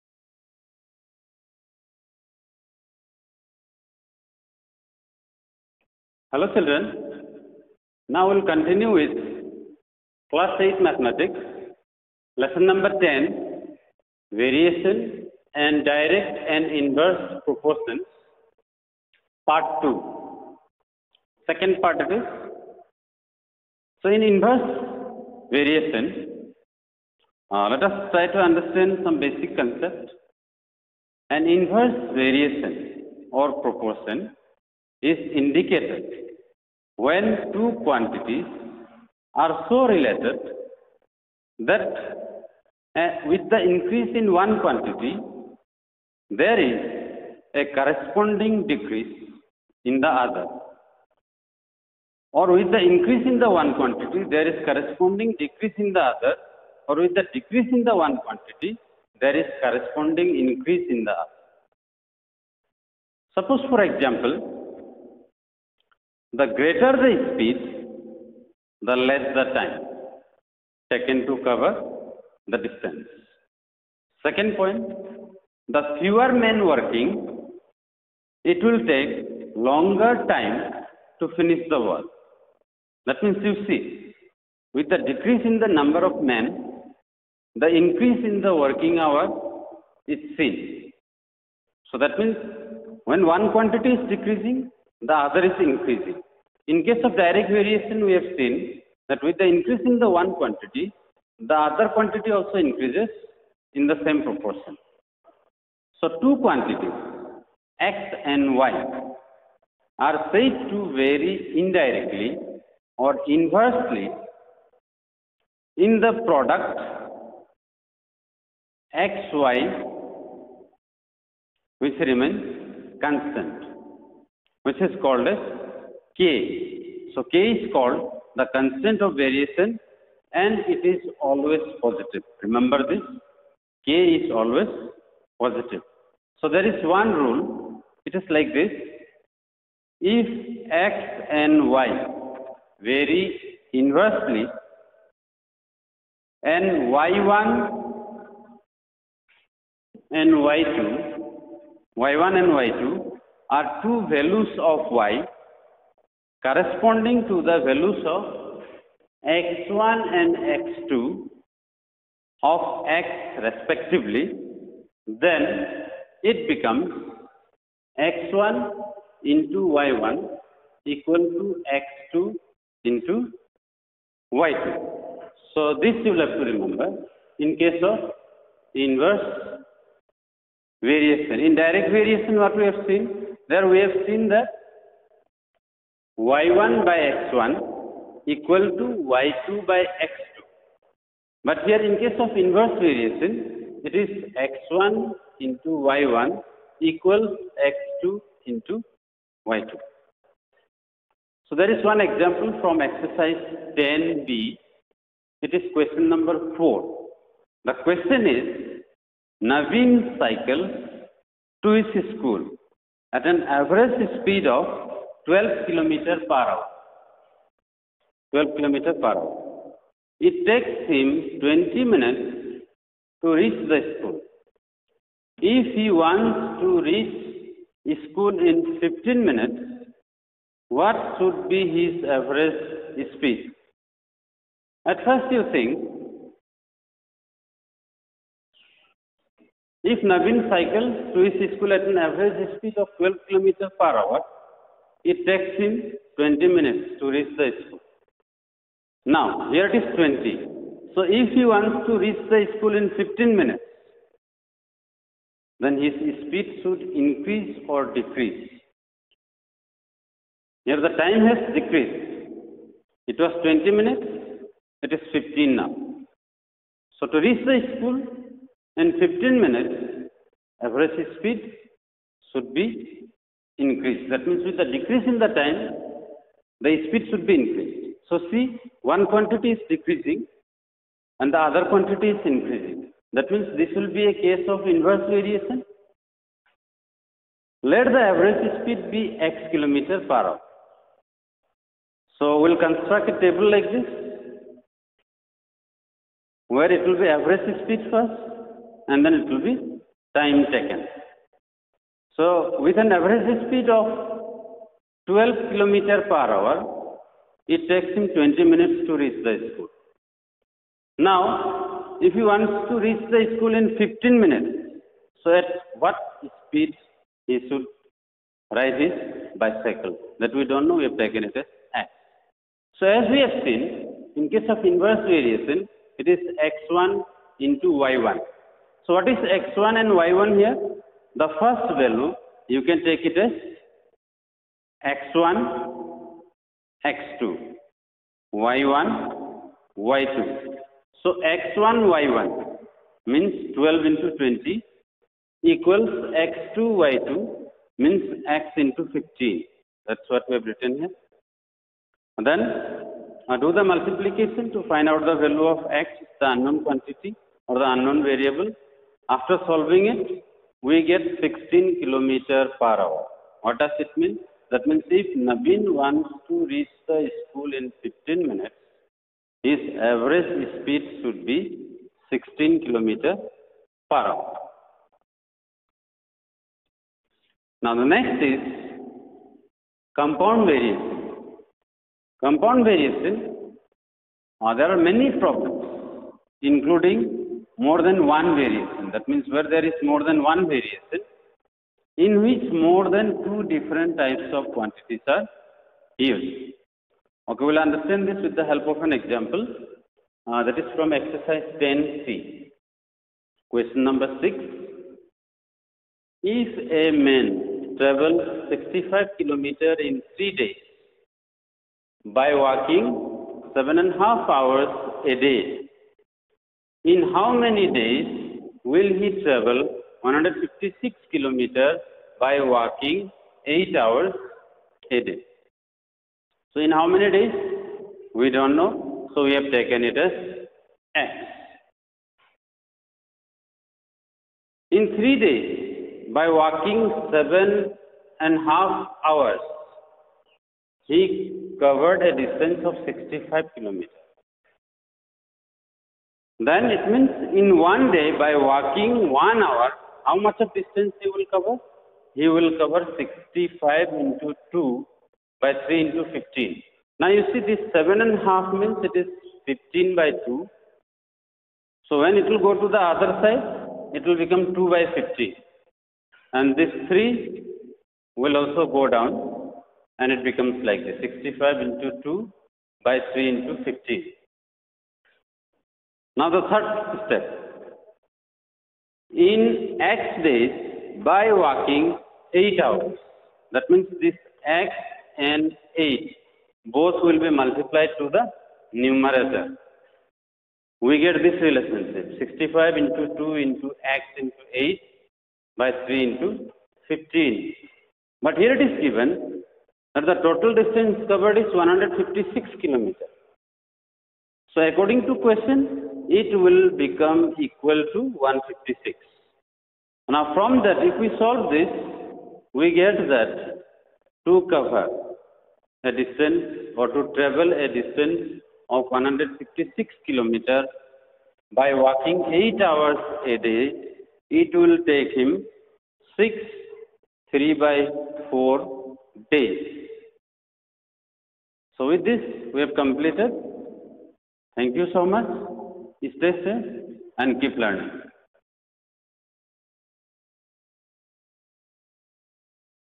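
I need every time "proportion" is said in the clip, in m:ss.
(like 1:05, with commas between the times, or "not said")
0:17, 0:33, 1:44.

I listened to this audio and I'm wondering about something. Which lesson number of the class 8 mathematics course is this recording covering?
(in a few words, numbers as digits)
10.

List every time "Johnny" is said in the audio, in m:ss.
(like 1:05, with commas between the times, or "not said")
not said.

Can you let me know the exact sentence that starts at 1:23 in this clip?
That means you see, with the decrease in the number of men, the increase in the working hour is seen.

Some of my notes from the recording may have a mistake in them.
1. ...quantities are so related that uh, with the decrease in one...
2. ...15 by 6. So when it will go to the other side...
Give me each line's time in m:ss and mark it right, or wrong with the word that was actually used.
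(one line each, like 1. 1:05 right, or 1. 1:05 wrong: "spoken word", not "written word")
1. 0:37 wrong: "increase", not "decrease"
2. 7:39 wrong: "2", not "6".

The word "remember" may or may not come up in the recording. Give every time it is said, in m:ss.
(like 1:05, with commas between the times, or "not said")
2:12, 2:56.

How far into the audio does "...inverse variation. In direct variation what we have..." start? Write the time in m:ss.
2:58.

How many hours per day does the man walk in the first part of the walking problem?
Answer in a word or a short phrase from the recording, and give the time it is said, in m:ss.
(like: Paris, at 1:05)
7.5 hours, at 6:53.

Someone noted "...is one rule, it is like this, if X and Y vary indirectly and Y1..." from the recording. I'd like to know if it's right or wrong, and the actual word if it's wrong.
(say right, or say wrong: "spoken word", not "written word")
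wrong: "inversely", not "indirectly".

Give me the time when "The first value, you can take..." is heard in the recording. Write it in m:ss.
5:31.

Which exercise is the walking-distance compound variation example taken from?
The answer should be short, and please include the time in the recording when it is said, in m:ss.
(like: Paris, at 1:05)
10C, at 6:40.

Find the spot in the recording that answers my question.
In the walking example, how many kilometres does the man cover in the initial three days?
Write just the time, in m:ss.
6:48.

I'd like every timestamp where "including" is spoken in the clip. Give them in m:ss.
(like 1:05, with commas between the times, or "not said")
6:26.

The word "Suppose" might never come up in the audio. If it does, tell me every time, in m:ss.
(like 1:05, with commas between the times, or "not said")
1:03.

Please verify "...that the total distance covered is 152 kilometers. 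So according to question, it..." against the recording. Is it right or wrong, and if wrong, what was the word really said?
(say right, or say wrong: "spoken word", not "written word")
wrong: "156", not "152".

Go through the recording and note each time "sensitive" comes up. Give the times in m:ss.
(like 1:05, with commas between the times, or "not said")
not said.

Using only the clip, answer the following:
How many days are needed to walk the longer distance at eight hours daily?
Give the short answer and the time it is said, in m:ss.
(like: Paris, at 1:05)
6 3/4 days, at 8:46.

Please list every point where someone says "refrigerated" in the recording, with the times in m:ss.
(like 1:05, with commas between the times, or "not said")
not said.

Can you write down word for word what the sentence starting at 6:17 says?
Now the next is compound variation.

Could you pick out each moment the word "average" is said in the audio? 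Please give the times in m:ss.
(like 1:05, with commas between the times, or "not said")
3:33, 3:52, 4:01, 4:30, 4:47, 4:57, 5:02, 6:09.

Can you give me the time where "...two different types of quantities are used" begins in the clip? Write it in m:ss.
6:33.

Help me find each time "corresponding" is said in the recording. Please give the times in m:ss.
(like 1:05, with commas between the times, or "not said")
0:47, 0:54, 0:59, 2:36.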